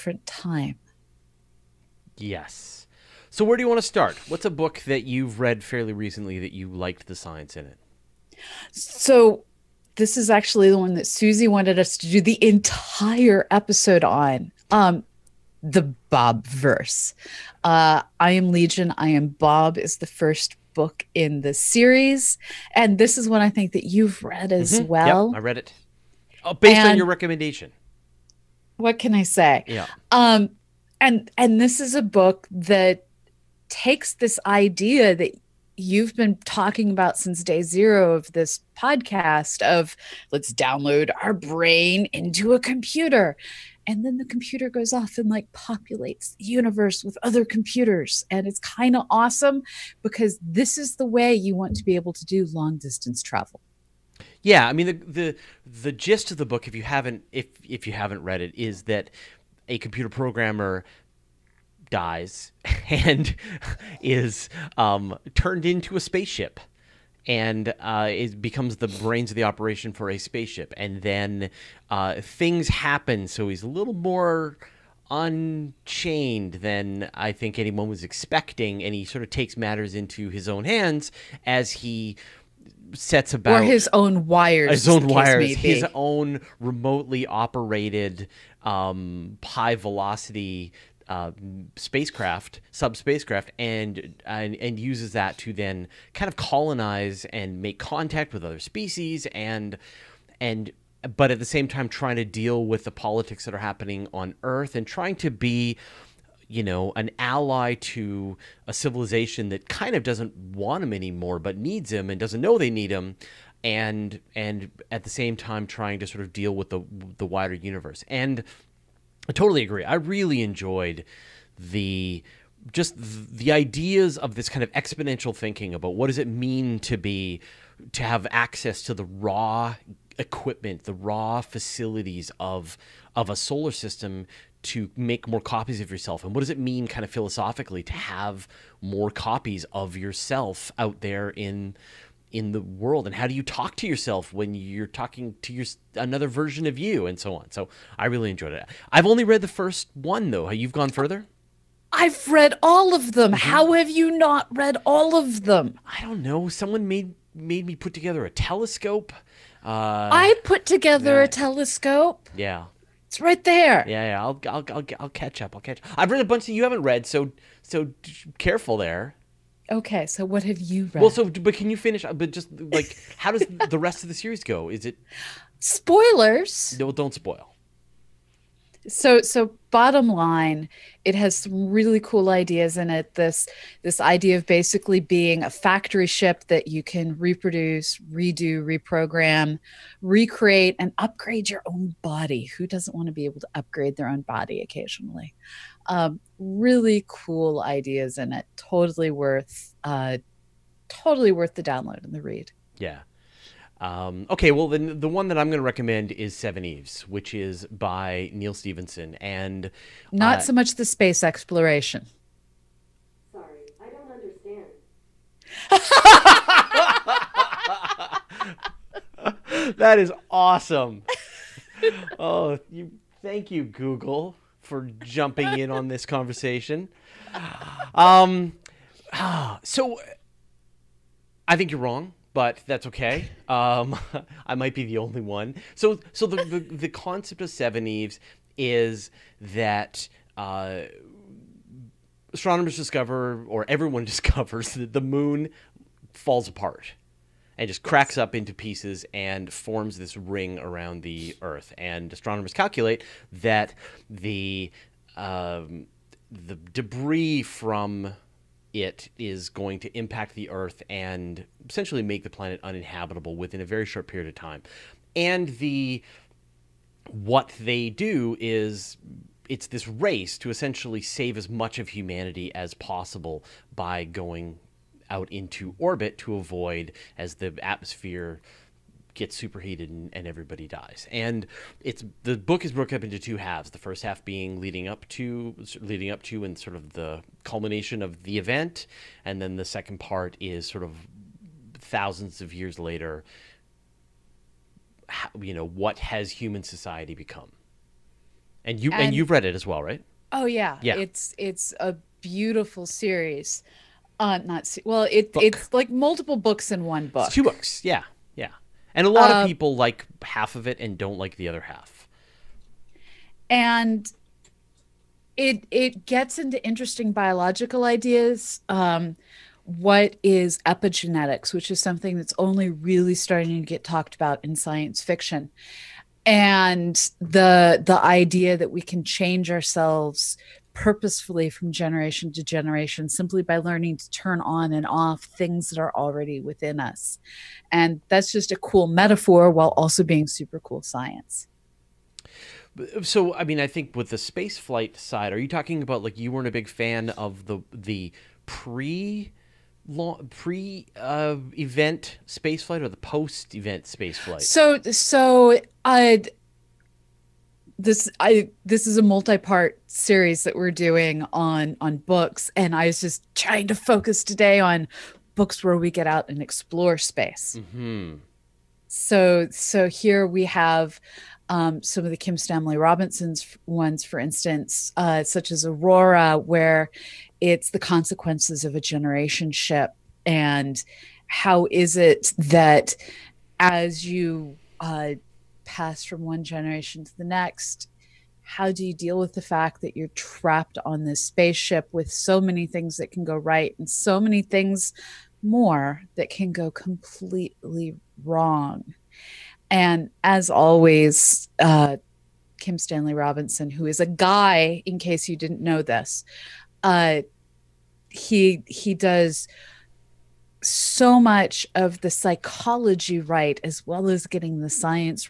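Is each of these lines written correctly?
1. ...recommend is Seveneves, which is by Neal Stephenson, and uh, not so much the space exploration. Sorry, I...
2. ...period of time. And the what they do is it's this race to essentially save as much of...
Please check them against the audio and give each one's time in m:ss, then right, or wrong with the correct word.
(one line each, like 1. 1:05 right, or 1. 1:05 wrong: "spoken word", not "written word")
1. 3:25 right
2. 4:24 right.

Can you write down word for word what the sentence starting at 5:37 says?
And that's just a cool metaphor while also being super cool science.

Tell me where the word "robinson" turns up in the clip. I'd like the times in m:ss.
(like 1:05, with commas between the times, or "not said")
6:12, 6:43.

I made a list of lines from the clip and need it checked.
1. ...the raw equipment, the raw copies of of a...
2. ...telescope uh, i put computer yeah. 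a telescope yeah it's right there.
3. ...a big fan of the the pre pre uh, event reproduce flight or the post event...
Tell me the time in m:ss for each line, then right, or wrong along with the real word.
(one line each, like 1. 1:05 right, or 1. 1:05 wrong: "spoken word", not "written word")
1. 2:08 wrong: "facilities", not "copies"
2. 2:38 wrong: "together", not "computer"
3. 5:46 wrong: "space", not "reproduce".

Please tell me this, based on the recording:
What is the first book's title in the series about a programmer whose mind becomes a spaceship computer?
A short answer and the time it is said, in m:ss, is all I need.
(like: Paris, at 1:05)
I am Legion, I am Bob, at 0:18.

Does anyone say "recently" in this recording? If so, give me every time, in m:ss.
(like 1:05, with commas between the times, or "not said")
0:05.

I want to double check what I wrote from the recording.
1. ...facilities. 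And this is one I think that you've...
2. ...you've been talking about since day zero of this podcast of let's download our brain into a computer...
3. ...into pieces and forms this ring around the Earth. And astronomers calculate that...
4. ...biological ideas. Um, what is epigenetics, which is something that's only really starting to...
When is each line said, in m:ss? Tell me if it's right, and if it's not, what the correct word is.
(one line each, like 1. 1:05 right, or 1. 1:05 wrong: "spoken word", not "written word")
1. 0:21 wrong: "series", not "facilities"
2. 0:35 right
3. 4:08 right
4. 5:17 right.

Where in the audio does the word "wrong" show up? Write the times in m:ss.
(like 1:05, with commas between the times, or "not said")
3:51, 6:38.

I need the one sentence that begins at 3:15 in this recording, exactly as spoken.
Um, really cool ideas in it.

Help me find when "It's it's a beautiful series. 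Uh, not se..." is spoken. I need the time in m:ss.
5:00.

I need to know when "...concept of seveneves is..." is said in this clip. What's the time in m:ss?
3:56.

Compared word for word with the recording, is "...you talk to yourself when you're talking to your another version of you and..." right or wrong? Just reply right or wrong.
right.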